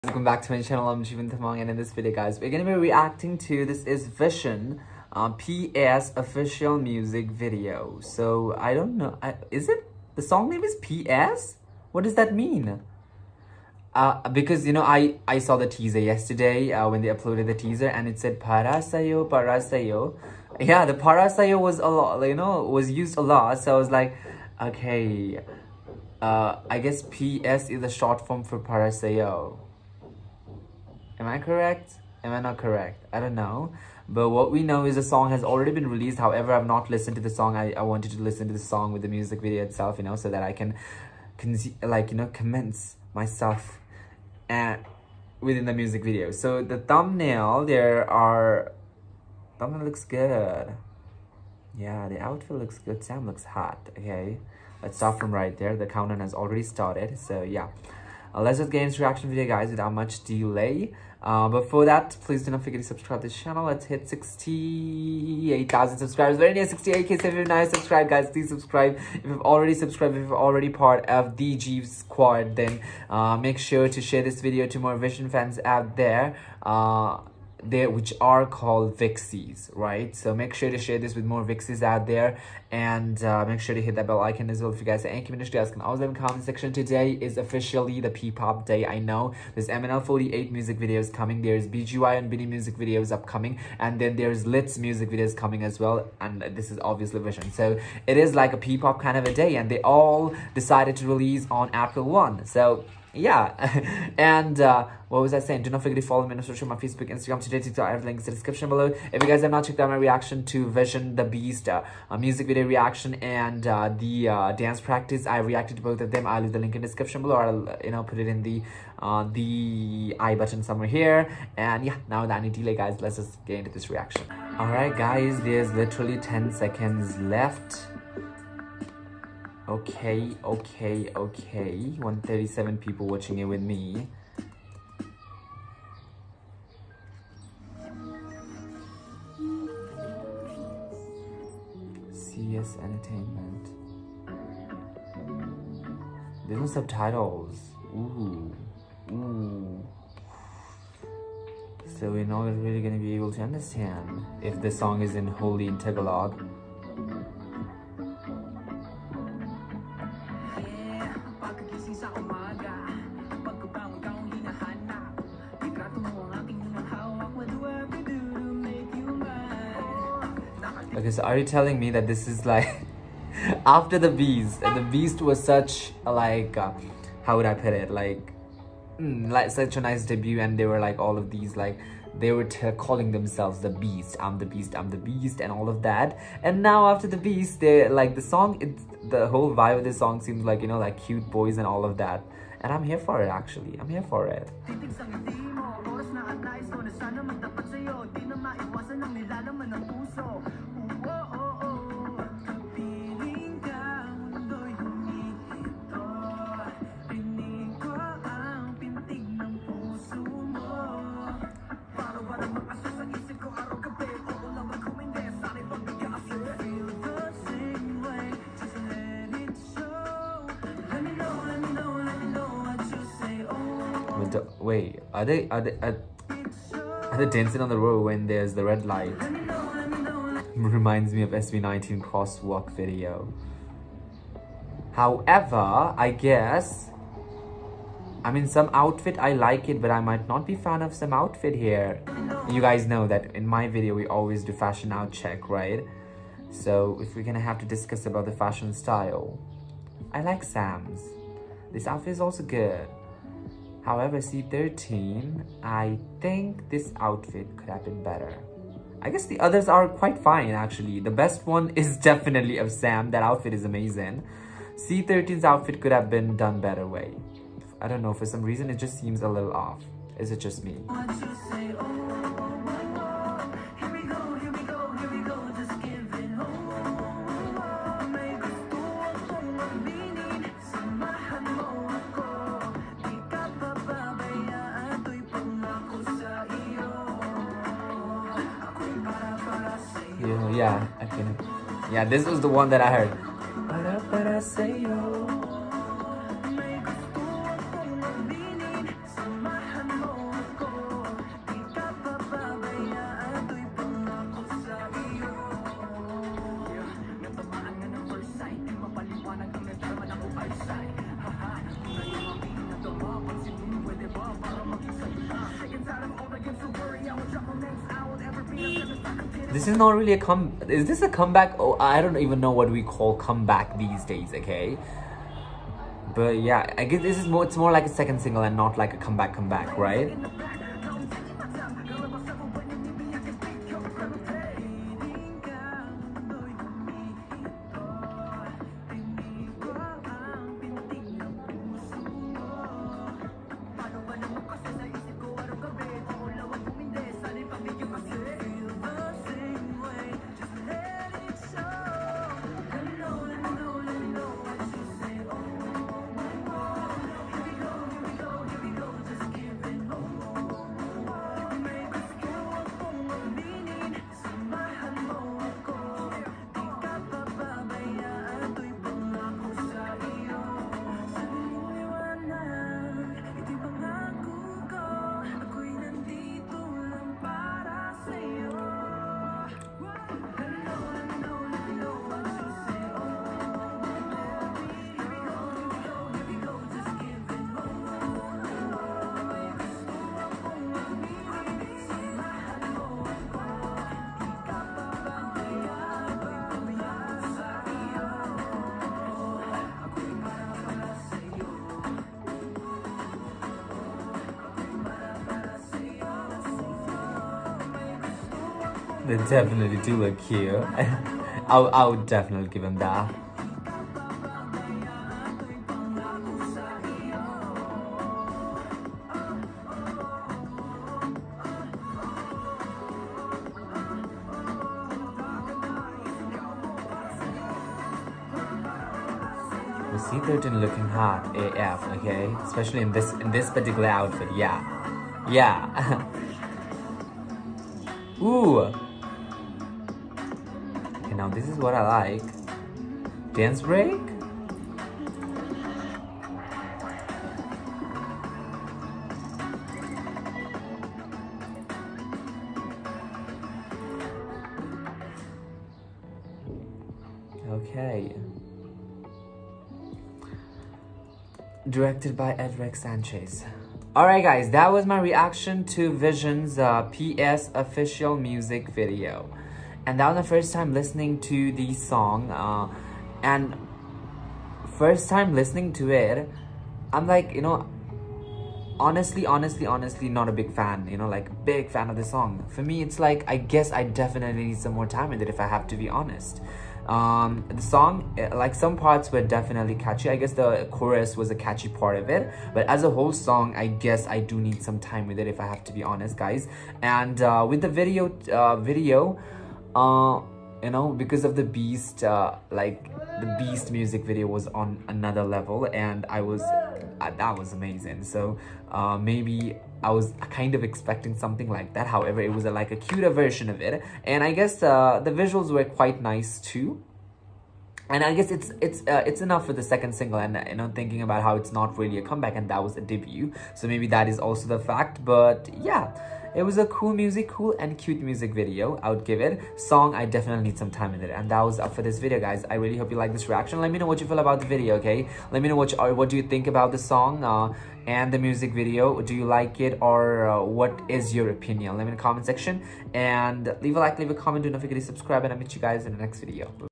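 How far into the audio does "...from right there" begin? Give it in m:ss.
0:55.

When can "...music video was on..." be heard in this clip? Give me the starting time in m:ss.
8:23.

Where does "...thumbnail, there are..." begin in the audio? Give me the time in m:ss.
0:46.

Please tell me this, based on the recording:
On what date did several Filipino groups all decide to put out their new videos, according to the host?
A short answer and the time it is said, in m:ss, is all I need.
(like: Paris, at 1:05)
April 1, at 1:41.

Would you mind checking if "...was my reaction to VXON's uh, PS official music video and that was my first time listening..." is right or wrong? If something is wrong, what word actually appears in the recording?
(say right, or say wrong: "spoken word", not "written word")
right.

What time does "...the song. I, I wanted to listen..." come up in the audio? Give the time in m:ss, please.
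0:37.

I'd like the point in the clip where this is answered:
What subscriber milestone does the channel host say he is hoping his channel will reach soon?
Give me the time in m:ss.
1:04.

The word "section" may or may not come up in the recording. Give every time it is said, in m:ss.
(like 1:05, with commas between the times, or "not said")
1:26, 9:02.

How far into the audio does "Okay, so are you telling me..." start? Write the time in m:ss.
2:50.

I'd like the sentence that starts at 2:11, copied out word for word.
137 people watching it with me.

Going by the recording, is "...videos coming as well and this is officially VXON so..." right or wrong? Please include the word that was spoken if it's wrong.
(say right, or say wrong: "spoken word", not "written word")
wrong: "obviously", not "officially".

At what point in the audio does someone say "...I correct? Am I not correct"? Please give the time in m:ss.
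0:31.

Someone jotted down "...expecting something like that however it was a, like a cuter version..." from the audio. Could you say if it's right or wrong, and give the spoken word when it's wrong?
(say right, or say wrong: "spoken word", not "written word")
right.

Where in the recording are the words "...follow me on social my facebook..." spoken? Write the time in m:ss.
1:46.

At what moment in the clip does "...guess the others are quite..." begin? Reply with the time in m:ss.
4:19.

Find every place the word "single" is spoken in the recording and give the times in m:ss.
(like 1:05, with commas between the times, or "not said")
5:28, 8:39.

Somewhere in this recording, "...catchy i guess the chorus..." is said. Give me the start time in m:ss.
8:09.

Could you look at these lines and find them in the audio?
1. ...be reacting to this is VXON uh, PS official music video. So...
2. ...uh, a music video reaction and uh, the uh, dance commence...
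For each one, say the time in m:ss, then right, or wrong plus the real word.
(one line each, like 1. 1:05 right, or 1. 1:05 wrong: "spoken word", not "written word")
1. 0:02 right
2. 1:51 wrong: "practice", not "commence".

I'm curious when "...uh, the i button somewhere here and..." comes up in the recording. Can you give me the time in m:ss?
1:58.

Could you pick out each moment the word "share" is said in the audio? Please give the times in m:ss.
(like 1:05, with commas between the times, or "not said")
1:14, 1:20.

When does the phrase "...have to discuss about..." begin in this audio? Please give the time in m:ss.
4:07.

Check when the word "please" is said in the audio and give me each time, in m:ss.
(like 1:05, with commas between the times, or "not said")
1:02, 1:08.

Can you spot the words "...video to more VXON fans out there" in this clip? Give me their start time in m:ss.
1:14.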